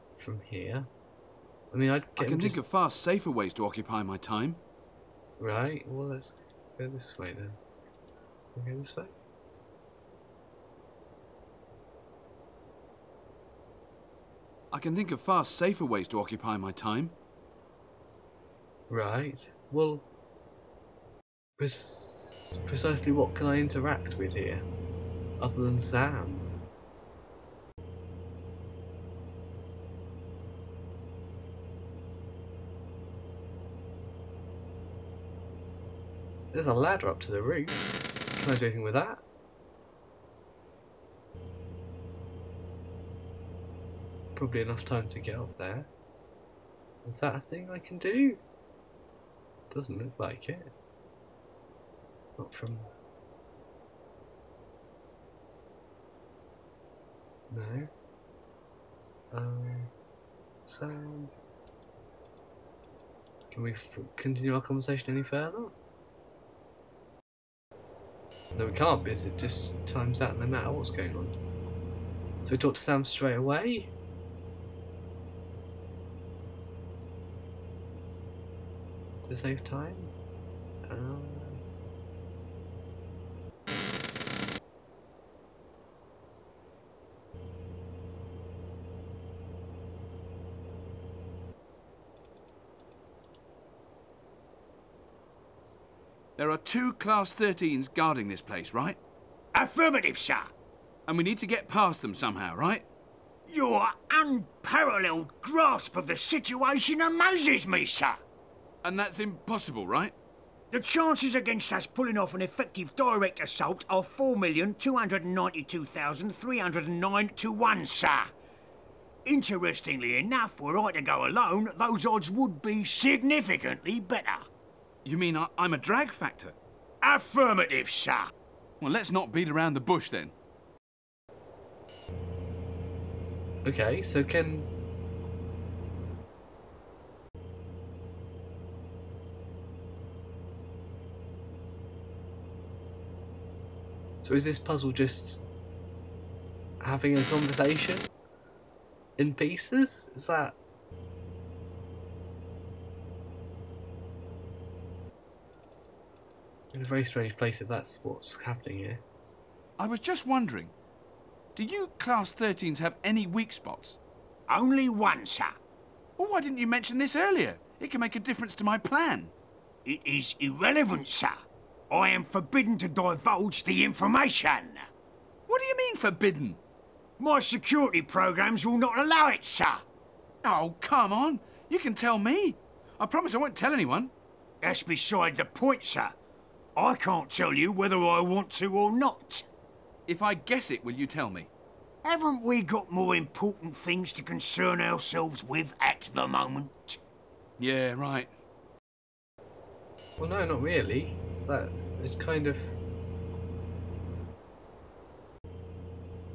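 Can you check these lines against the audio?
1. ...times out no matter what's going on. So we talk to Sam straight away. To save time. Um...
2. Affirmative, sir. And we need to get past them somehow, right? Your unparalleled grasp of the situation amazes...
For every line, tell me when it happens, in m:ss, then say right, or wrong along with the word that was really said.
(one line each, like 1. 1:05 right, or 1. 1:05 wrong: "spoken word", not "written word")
1. 1:09 right
2. 1:39 right.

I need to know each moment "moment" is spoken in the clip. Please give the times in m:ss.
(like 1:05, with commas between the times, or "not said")
3:16.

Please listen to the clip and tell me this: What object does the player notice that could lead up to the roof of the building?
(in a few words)
Ladder.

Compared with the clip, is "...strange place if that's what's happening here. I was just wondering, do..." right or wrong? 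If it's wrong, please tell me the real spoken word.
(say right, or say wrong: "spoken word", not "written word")
right.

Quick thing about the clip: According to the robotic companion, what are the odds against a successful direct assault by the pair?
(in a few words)
4,292,309 to 1.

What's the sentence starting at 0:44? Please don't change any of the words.
Probably enough time to get up there.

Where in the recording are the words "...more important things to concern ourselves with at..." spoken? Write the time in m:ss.
3:12.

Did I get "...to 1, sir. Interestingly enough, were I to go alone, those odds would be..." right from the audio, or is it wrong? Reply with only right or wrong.
right.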